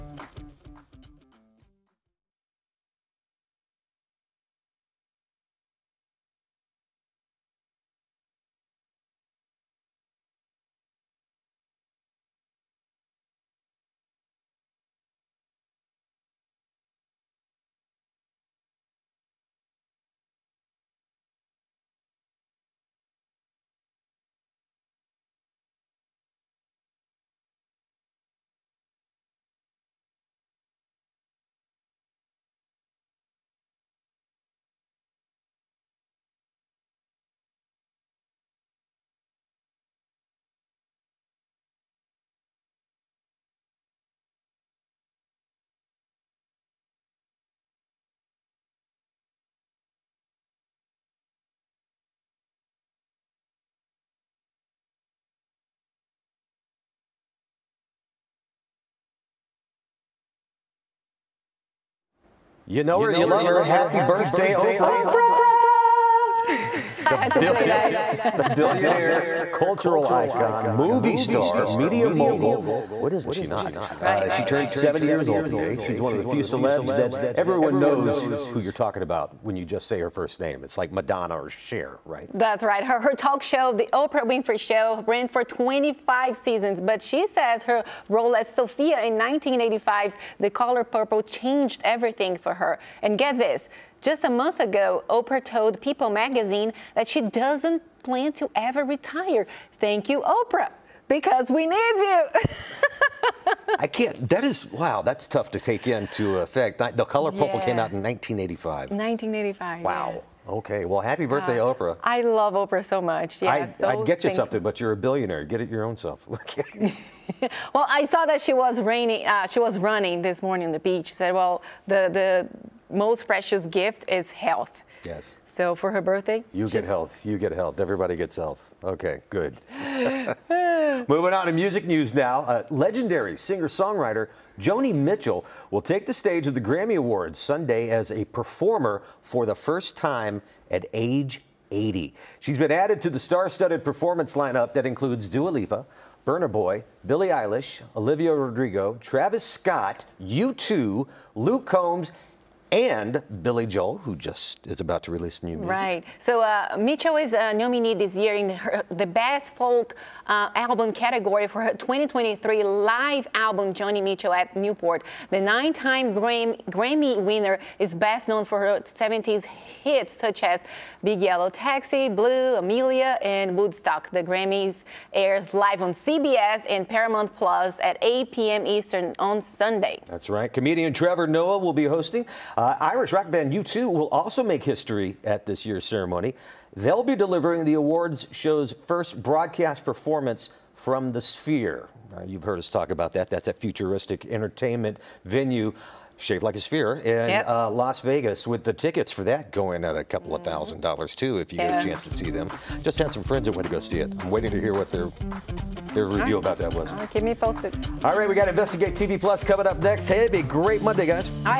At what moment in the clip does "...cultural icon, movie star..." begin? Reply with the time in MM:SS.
01:09.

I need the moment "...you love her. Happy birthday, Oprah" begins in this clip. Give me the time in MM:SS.
01:03.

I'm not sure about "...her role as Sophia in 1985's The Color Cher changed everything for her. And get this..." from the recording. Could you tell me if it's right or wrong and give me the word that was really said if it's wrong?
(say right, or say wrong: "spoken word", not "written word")
wrong: "Purple", not "Cher".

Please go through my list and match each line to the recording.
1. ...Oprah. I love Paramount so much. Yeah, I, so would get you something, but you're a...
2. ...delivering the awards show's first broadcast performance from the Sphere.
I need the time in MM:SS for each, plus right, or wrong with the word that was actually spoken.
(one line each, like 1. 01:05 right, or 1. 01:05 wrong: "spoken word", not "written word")
1. 01:51 wrong: "Oprah", not "Paramount"
2. 03:07 right.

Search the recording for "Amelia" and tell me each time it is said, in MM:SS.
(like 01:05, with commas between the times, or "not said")
02:52.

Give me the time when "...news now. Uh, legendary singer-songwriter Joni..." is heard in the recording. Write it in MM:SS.
02:11.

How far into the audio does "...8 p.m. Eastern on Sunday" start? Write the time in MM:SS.
02:58.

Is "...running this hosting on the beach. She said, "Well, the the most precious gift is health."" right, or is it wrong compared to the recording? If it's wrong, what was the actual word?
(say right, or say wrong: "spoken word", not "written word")
wrong: "morning", not "hosting".